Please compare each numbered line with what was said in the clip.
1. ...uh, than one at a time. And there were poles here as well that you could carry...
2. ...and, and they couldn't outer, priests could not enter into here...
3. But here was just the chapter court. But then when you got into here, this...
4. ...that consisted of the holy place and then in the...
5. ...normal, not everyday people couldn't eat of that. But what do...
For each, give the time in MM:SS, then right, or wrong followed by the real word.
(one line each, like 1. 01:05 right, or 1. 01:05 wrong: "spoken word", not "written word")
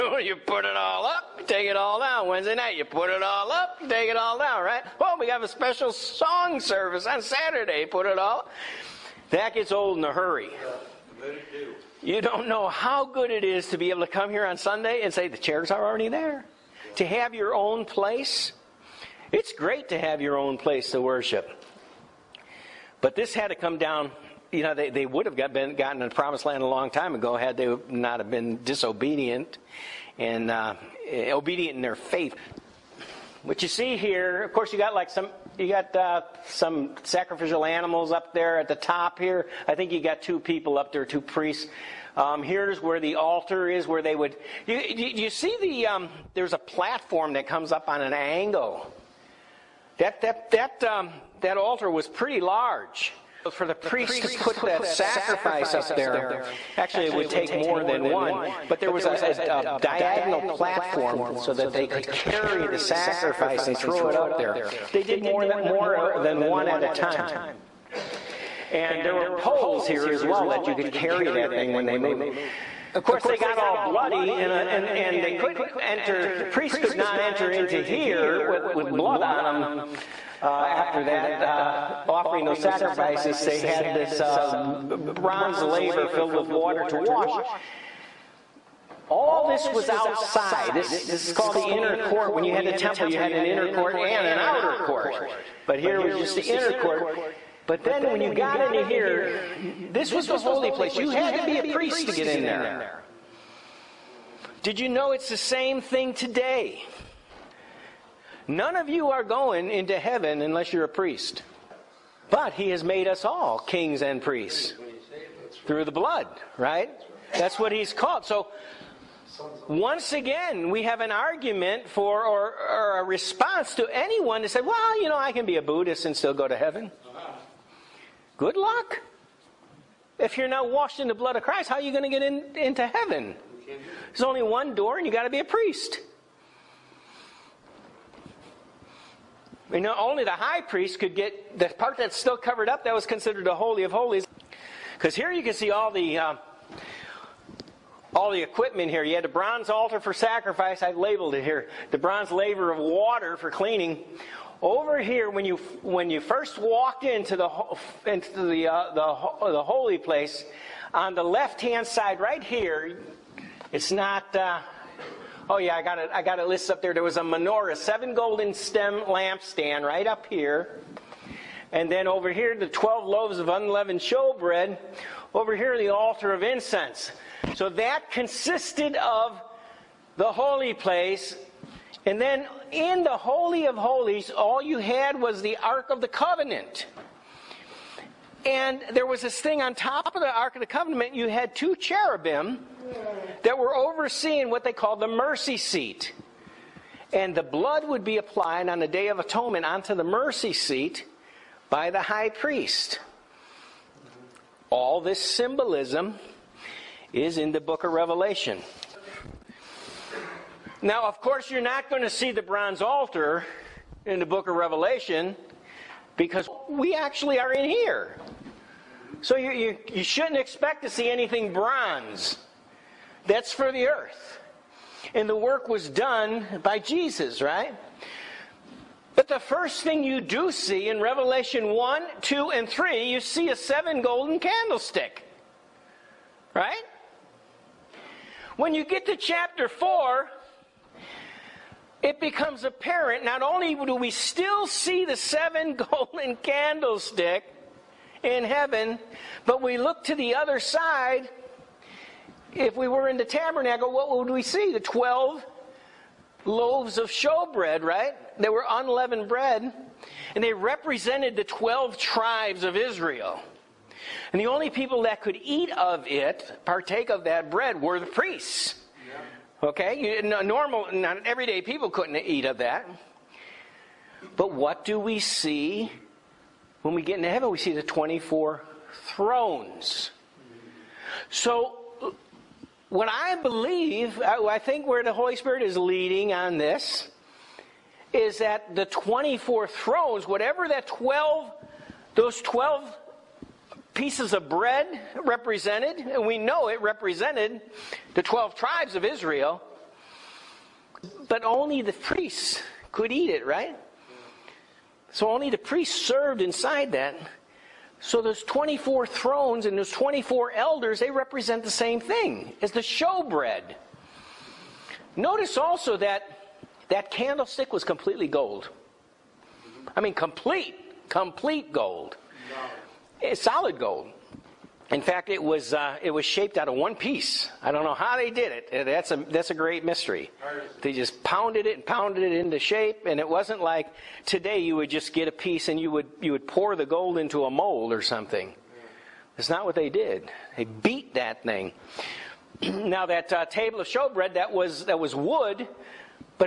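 1. 01:05 right
2. 01:14 wrong: "enter", not "outer"
3. 01:35 wrong: "inner", not "chapter"
4. 02:57 right
5. 04:30 right.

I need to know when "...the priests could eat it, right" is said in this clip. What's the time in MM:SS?
05:01.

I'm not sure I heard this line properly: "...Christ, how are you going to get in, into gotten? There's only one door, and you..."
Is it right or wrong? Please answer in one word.
wrong.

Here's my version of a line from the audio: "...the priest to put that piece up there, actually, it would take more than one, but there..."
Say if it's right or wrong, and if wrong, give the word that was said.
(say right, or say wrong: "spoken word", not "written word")
wrong: "sacrifice", not "piece".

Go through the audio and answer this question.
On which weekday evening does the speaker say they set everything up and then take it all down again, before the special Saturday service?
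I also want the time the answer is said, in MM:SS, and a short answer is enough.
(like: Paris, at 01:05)
Wednesday, at 00:02.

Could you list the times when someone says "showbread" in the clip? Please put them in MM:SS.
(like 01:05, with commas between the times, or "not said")
02:54, 04:17, 05:12, 05:43.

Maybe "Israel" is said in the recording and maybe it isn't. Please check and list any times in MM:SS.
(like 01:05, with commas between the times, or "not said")
04:22, 04:59.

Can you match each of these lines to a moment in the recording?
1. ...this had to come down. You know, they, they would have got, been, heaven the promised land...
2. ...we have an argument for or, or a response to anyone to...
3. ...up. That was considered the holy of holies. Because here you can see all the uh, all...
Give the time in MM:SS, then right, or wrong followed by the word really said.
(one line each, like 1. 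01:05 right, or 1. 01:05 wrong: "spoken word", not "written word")
1. 00:23 wrong: "gotten", not "heaven"
2. 02:00 right
3. 02:22 right.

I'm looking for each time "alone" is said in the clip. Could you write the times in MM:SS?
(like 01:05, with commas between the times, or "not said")
not said.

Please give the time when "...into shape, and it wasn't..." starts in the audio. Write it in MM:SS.
05:32.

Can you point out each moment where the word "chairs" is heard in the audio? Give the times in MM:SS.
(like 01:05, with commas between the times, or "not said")
00:15.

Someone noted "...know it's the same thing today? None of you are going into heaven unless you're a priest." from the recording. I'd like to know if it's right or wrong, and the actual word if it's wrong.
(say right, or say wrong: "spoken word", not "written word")
right.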